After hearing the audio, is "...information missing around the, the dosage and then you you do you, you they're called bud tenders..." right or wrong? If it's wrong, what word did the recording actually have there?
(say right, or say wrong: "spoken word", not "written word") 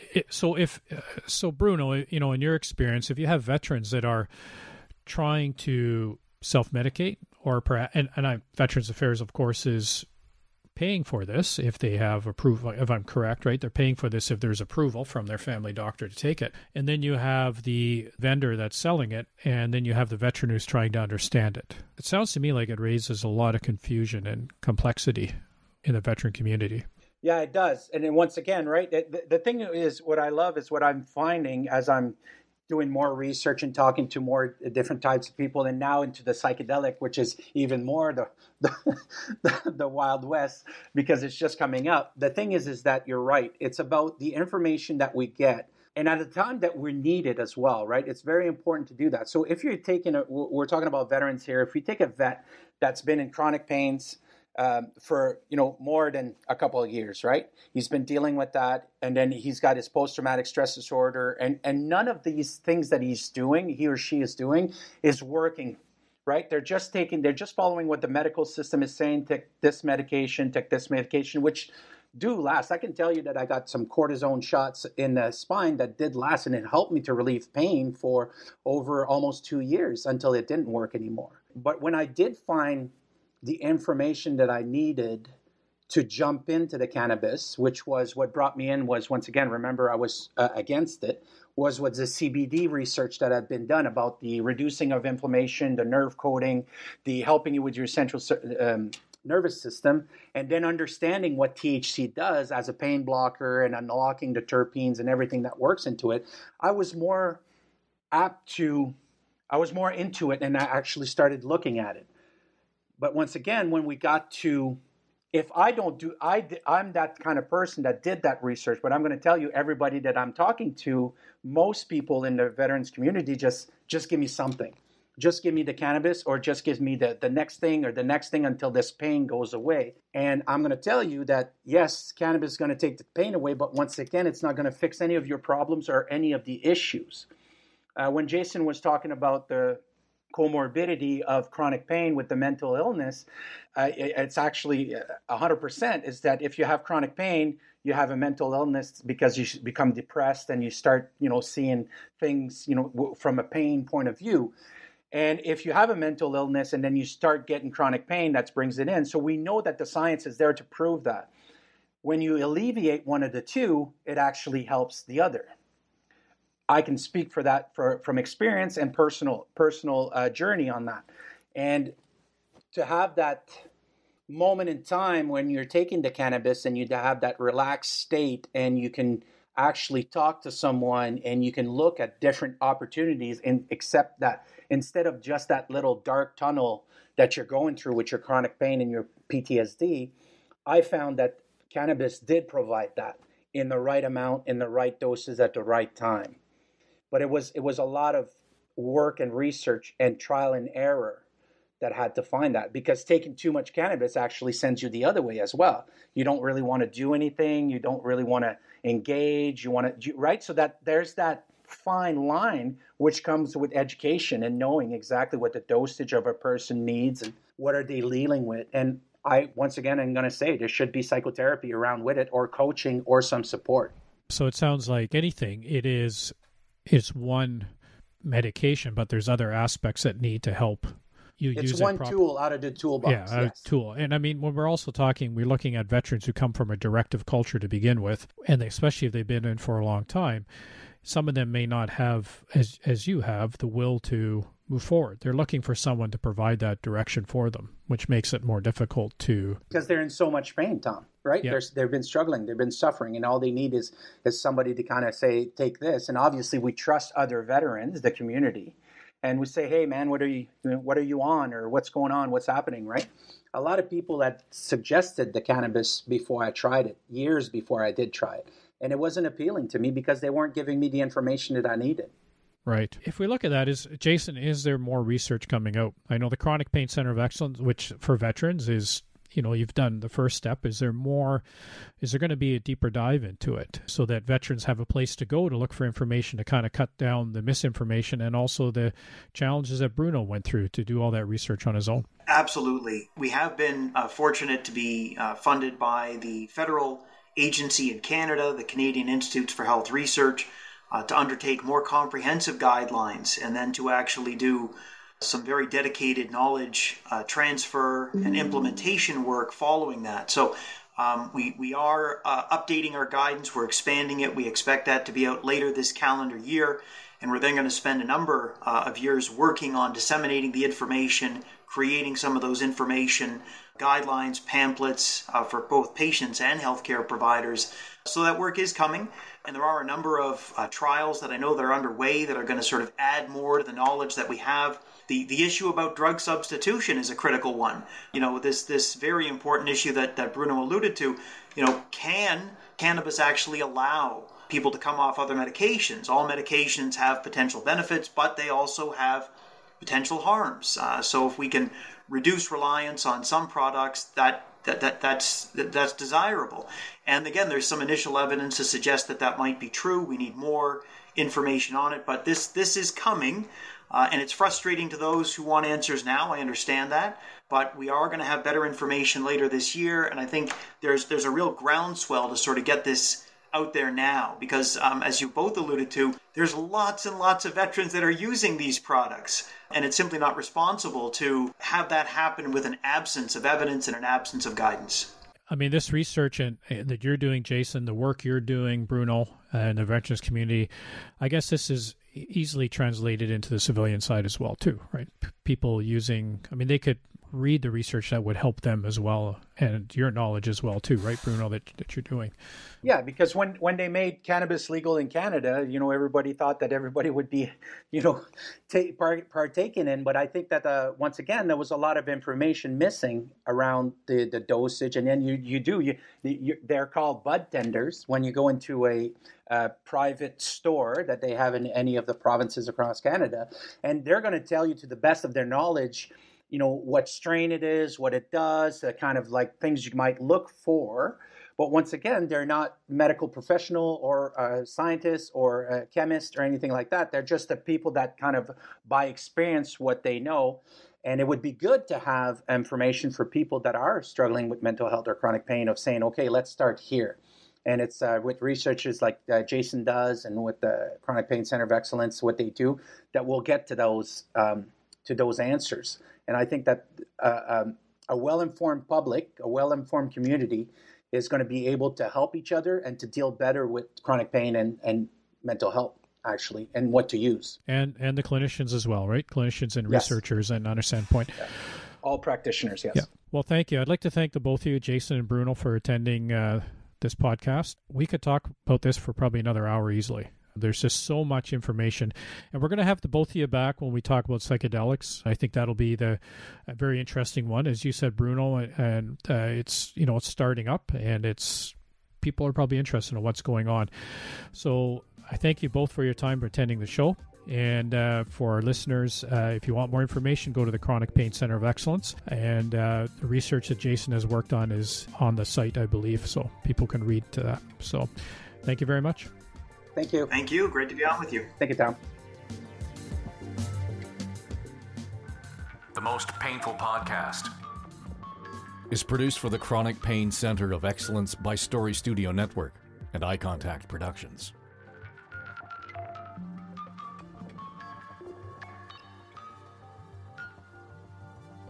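right.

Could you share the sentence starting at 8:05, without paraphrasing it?
I think that'll be the very interesting one, as you said, Bruno.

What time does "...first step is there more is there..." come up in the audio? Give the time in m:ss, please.
4:40.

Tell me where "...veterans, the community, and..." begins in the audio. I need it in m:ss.
4:17.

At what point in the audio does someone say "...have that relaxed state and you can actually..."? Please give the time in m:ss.
2:56.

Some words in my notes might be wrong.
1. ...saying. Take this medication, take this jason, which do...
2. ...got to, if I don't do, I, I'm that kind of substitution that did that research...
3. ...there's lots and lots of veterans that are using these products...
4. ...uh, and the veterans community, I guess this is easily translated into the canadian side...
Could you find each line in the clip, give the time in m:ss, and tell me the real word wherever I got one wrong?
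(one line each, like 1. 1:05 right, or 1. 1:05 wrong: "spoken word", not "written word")
1. 1:08 wrong: "medication", not "jason"
2. 1:53 wrong: "person", not "substitution"
3. 6:16 right
4. 6:29 wrong: "civilian", not "canadian".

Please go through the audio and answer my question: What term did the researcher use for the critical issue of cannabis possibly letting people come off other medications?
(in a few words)
Drug substitution.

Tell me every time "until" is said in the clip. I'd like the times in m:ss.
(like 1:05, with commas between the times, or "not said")
1:20, 2:08.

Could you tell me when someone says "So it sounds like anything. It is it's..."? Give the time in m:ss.
3:44.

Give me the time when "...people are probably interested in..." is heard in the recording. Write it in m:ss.
8:12.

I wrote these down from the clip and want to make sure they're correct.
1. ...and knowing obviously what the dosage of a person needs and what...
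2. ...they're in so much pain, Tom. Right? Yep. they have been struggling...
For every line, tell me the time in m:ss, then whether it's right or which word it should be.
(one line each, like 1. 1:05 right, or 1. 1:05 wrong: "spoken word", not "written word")
1. 3:34 wrong: "exactly", not "obviously"
2. 4:09 right.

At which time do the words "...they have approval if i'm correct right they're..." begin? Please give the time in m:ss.
0:11.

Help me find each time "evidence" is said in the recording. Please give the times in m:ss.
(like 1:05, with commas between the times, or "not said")
5:58, 6:23.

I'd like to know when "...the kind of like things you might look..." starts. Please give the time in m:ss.
7:08.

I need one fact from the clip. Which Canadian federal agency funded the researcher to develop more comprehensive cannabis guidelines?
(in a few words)
Canadian Institutes for Health Research.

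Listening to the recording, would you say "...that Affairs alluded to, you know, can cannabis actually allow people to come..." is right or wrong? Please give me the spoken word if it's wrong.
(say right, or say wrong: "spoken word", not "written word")
wrong: "Bruno", not "Affairs".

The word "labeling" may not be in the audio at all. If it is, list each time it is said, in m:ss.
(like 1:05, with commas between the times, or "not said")
not said.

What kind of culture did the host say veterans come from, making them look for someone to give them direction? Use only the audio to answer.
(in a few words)
Directive culture.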